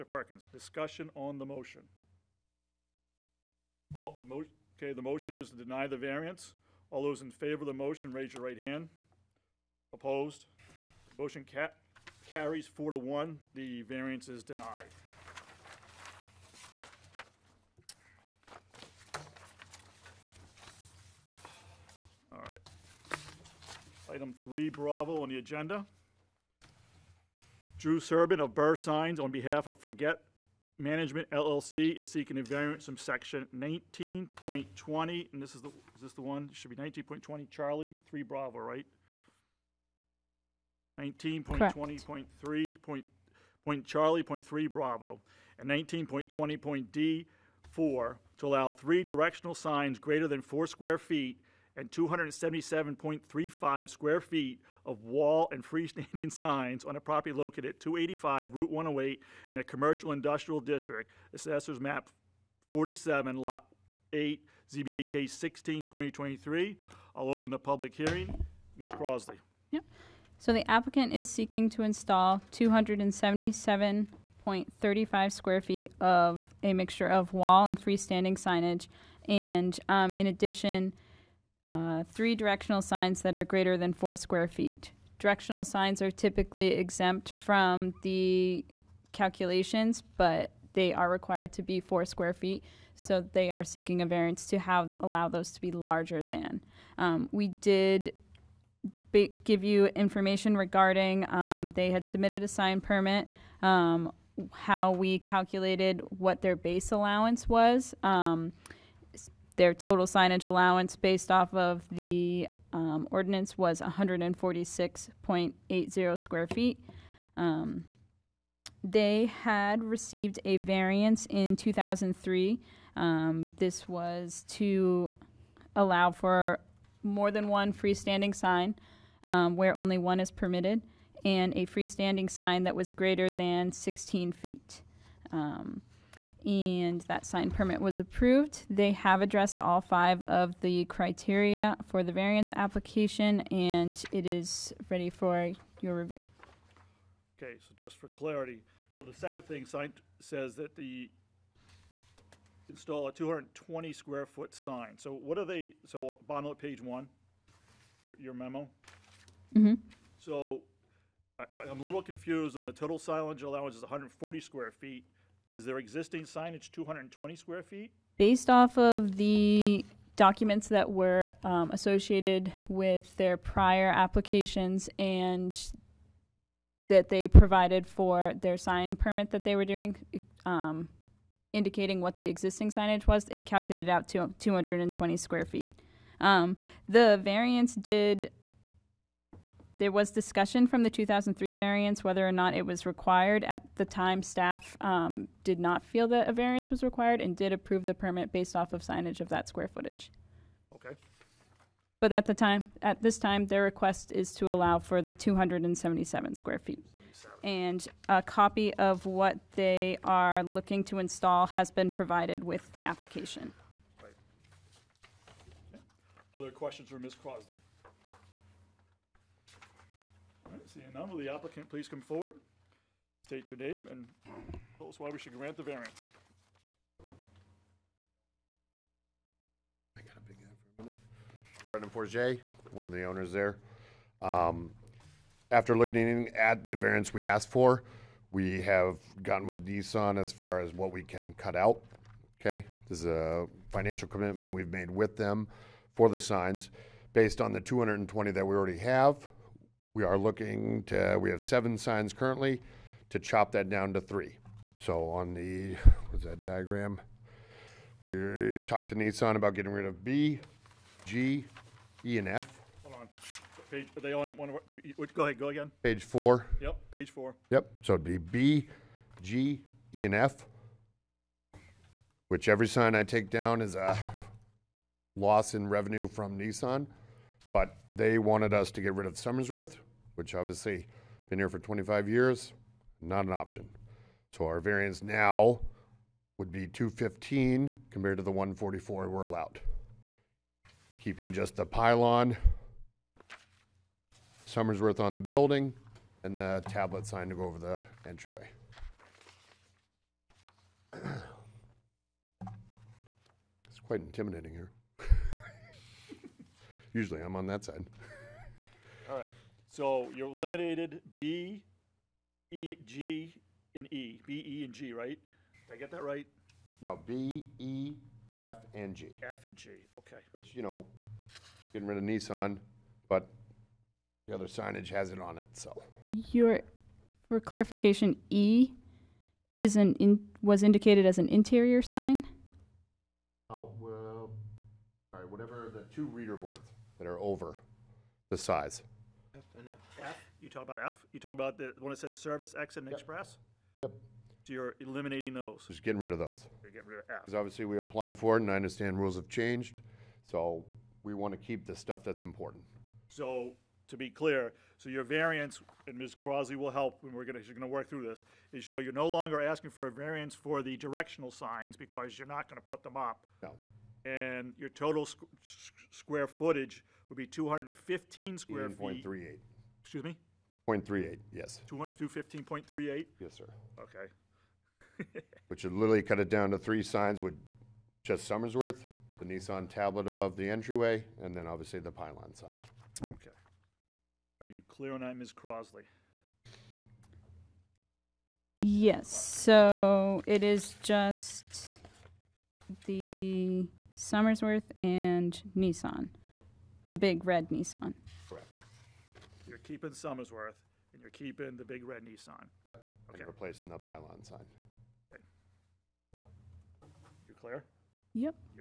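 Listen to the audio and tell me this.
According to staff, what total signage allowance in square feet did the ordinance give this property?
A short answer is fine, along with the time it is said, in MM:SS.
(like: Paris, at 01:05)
146.80, at 01:53.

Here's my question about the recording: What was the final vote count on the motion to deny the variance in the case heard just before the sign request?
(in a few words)
4 to 1.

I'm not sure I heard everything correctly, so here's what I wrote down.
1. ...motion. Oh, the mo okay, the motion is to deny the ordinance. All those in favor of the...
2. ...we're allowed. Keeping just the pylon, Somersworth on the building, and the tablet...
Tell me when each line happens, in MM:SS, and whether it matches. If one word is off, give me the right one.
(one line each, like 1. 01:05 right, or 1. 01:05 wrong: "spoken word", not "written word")
1. 00:01 wrong: "variance", not "ordinance"
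2. 04:49 right.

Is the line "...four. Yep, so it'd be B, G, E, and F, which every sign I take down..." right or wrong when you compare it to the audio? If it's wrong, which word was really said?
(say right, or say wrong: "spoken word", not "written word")
right.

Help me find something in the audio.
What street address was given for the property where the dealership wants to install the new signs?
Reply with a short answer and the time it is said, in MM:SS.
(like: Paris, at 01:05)
285 Route 108, at 00:57.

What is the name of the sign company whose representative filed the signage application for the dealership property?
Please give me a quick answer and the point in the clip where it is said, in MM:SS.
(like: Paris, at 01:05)
Burr Signs, at 00:28.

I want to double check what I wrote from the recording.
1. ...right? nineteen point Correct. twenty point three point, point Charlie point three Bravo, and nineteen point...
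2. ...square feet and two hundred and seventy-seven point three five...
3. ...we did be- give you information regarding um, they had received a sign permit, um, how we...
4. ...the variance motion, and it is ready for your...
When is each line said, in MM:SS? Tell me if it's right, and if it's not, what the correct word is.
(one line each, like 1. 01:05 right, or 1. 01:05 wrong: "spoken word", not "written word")
1. 00:38 right
2. 00:50 right
3. 01:37 wrong: "submitted", not "received"
4. 02:22 wrong: "application", not "motion".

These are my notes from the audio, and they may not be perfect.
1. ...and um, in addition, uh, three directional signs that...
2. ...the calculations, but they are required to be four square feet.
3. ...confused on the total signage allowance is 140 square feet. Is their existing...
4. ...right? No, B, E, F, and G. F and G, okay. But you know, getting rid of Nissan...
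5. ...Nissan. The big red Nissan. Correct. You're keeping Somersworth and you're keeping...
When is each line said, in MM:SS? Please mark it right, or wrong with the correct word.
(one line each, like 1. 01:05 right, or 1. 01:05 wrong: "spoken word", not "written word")
1. 01:19 right
2. 01:28 right
3. 02:42 right
4. 05:16 right
5. 06:35 right.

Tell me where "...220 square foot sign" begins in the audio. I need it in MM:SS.
02:33.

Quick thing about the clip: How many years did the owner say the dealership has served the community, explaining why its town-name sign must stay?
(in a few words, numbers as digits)
25.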